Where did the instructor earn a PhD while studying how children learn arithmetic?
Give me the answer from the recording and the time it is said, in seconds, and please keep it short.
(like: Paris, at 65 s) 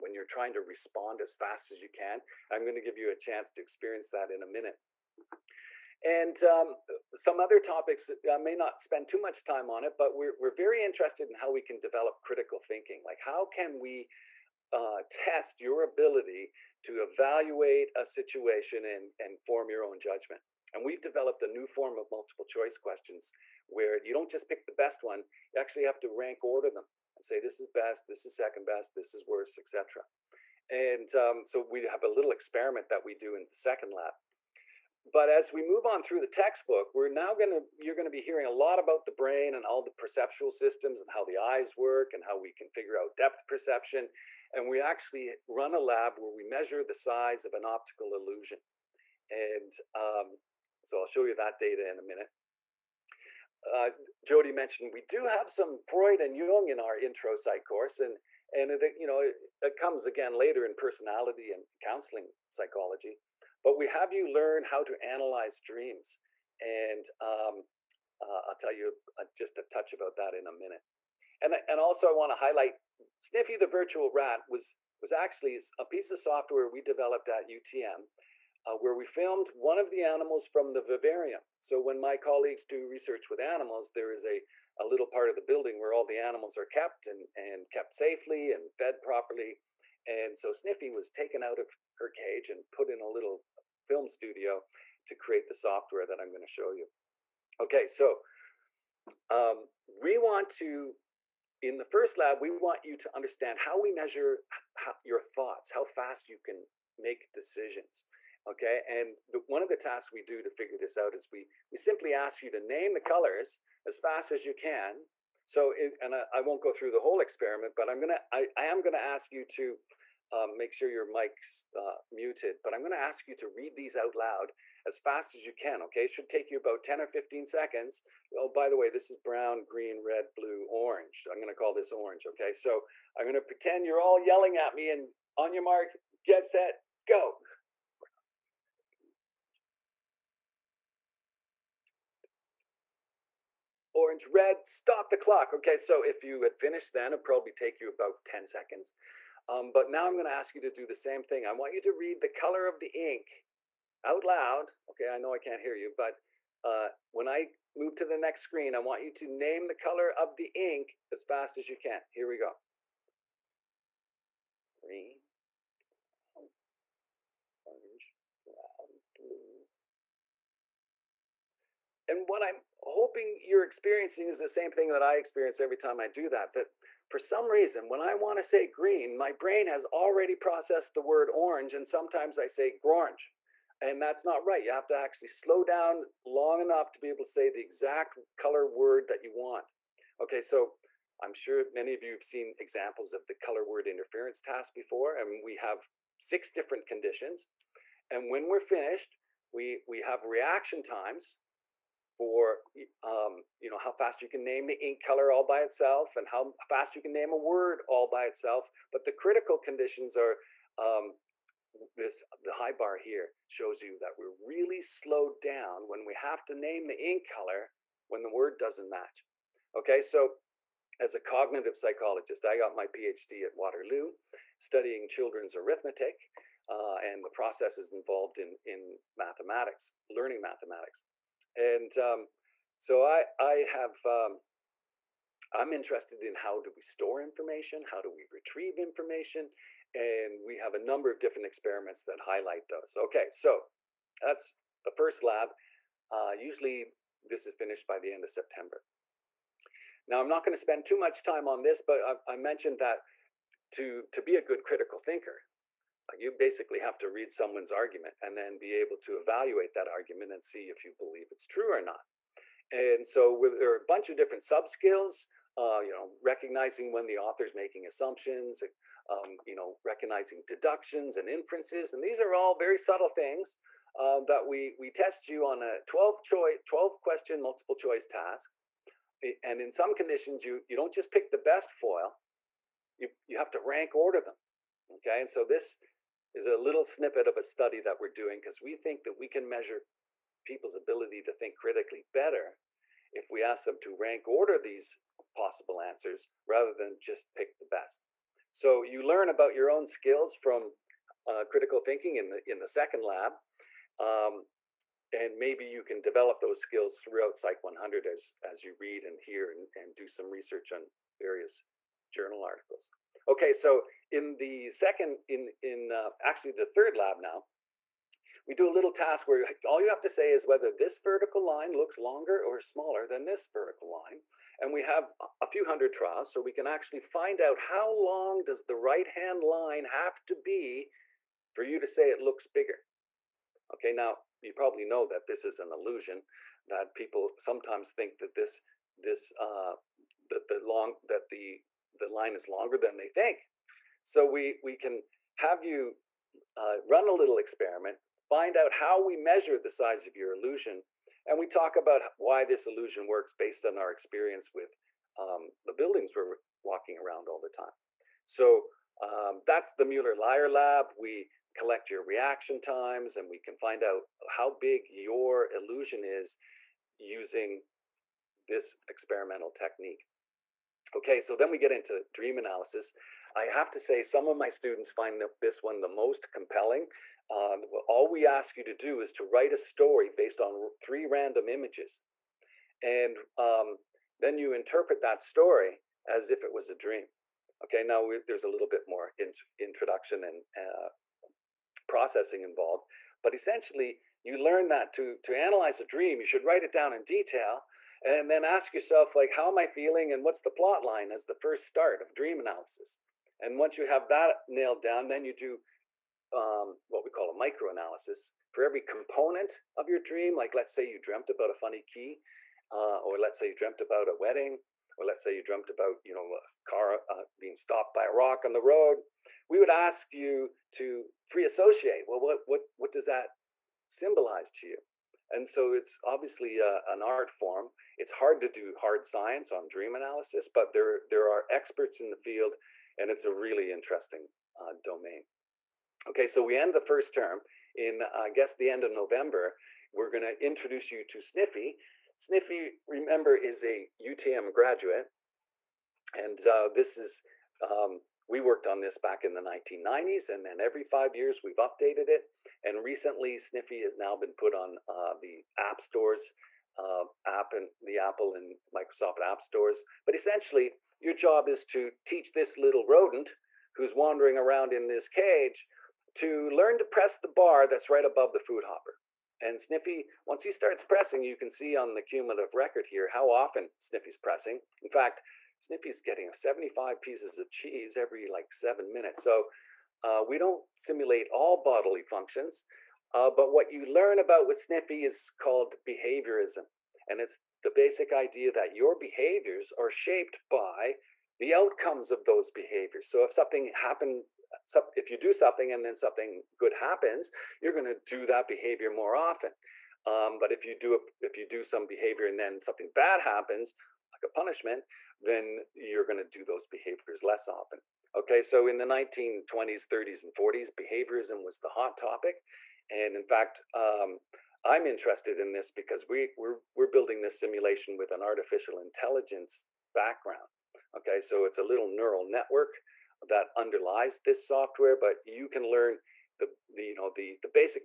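Waterloo, at 223 s.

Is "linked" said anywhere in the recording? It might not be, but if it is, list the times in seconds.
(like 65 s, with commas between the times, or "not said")
not said.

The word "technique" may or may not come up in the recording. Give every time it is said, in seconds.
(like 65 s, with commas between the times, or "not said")
369 s.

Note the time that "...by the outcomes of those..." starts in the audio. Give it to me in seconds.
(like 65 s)
490 s.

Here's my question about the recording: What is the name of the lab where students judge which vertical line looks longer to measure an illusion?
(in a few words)
Müller-Lyer Lab.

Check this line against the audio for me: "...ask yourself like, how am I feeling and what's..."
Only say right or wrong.
right.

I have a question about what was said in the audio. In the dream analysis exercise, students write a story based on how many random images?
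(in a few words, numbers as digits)
3.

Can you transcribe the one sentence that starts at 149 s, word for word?
Um, but now I'm gonna ask you to do the same thing.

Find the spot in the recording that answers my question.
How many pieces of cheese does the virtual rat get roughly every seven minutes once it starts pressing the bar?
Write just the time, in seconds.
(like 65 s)
476 s.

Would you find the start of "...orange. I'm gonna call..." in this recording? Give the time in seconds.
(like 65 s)
130 s.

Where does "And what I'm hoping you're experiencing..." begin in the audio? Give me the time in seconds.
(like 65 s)
172 s.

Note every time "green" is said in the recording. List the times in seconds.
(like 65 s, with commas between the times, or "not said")
129 s, 164 s, 178 s.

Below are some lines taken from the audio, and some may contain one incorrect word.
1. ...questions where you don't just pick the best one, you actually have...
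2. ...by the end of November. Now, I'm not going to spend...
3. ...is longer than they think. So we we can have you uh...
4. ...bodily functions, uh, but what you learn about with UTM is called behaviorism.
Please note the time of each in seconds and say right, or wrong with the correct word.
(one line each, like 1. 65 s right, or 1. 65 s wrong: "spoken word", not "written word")
1. 22 s right
2. 247 s wrong: "September", not "November"
3. 342 s right
4. 481 s wrong: "Sniffy", not "UTM".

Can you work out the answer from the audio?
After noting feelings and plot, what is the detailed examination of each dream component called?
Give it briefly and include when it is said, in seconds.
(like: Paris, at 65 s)
microanalysis, at 407 s.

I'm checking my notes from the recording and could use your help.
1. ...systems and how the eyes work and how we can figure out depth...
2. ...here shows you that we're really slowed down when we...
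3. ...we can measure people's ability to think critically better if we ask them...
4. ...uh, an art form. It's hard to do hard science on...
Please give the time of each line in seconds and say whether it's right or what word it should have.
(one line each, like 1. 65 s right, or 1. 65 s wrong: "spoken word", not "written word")
1. 40 s right
2. 212 s right
3. 289 s right
4. 426 s right.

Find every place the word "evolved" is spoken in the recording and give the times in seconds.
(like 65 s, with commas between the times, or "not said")
not said.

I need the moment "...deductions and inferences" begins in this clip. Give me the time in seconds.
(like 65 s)
270 s.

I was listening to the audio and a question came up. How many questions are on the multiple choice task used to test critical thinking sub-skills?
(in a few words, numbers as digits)
12.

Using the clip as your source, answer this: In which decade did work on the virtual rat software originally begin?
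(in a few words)
1990s.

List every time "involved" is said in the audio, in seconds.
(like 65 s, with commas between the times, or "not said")
227 s, 392 s.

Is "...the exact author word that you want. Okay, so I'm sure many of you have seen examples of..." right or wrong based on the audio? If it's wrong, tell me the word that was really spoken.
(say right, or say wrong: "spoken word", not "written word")
wrong: "color", not "author".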